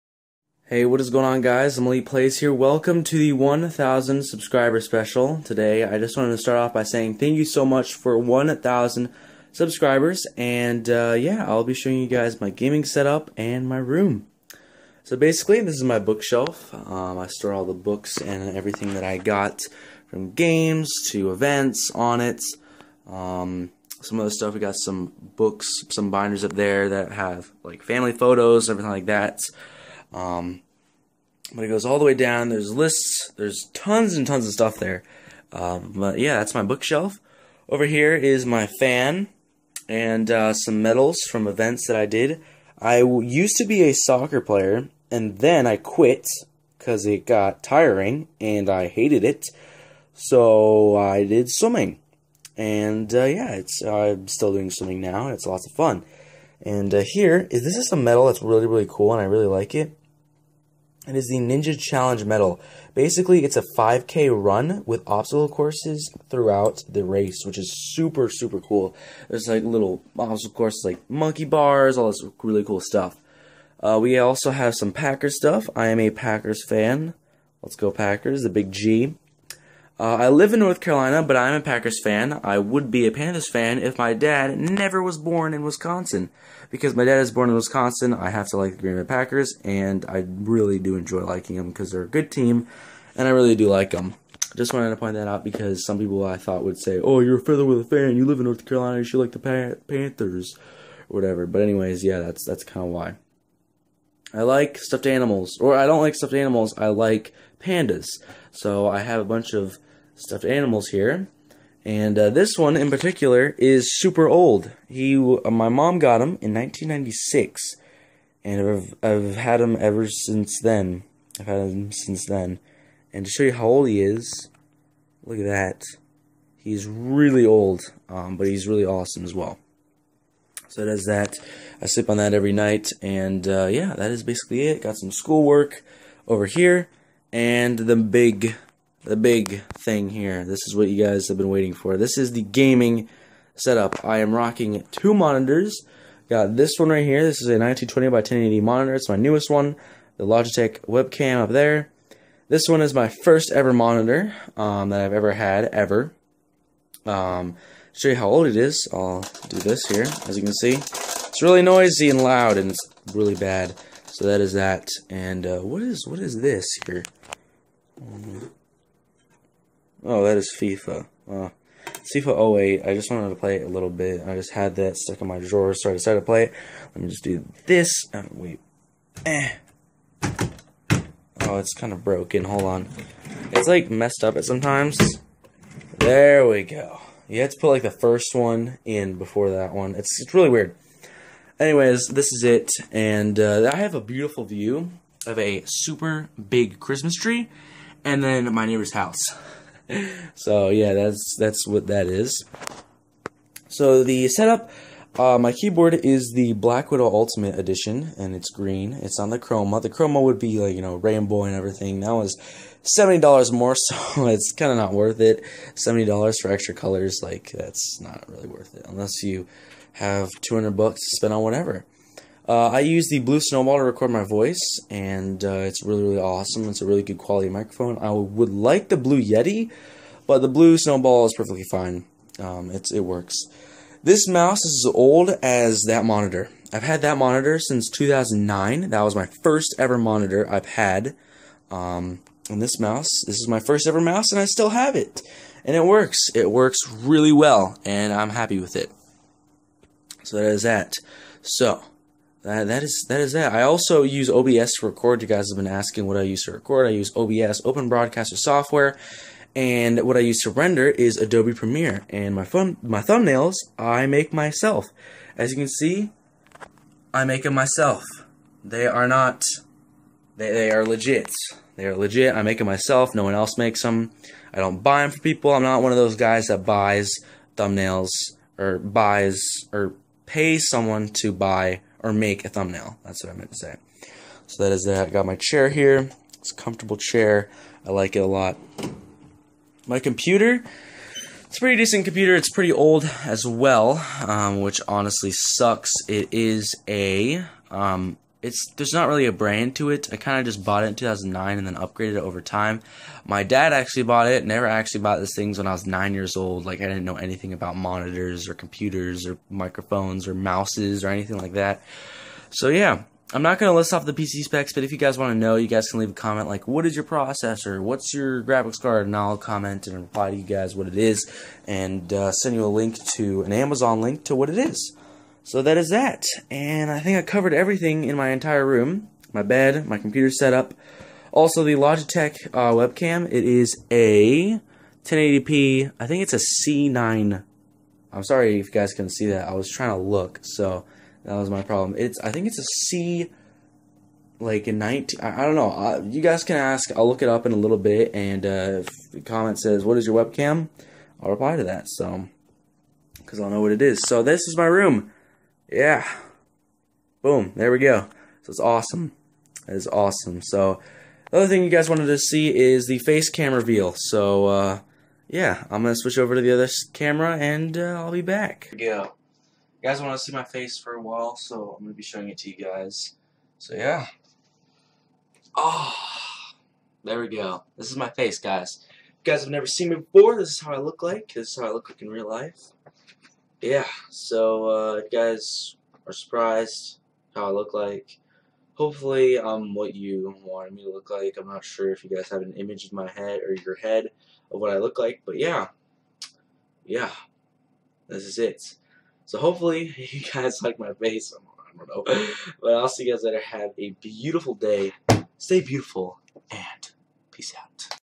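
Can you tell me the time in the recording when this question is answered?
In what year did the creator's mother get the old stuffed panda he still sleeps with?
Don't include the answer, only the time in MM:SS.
01:56.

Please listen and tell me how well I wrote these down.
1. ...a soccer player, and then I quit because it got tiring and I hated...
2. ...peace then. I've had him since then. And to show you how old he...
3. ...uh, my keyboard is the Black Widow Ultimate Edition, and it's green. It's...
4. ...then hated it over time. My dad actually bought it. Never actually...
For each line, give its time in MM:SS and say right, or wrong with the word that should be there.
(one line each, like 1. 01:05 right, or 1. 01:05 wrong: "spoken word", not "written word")
1. 00:43 right
2. 02:00 wrong: "since", not "peace"
3. 03:25 right
4. 05:01 wrong: "upgraded", not "hated".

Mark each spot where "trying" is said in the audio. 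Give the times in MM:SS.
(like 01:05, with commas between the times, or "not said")
05:39.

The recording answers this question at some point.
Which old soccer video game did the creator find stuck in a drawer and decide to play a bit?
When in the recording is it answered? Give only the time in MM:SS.
02:51.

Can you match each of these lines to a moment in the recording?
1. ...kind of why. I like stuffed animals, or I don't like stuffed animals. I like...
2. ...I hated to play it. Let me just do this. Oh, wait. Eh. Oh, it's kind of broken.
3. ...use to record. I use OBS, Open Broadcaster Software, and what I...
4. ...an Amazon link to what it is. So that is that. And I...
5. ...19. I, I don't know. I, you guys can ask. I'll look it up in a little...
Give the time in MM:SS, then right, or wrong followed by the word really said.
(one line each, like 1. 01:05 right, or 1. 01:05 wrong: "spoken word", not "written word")
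1. 01:42 right
2. 02:55 wrong: "decided", not "hated"
3. 04:16 right
4. 05:23 right
5. 05:44 right.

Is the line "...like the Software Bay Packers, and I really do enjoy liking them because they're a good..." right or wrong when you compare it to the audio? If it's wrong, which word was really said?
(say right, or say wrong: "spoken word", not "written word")
wrong: "Green", not "Software".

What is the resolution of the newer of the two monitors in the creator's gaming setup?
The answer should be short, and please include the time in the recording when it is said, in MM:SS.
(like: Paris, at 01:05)
1920 by 1080, at 02:27.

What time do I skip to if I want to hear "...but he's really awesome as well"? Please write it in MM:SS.
02:08.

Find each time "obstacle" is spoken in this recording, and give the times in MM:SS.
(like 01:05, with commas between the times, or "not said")
01:05, 01:10.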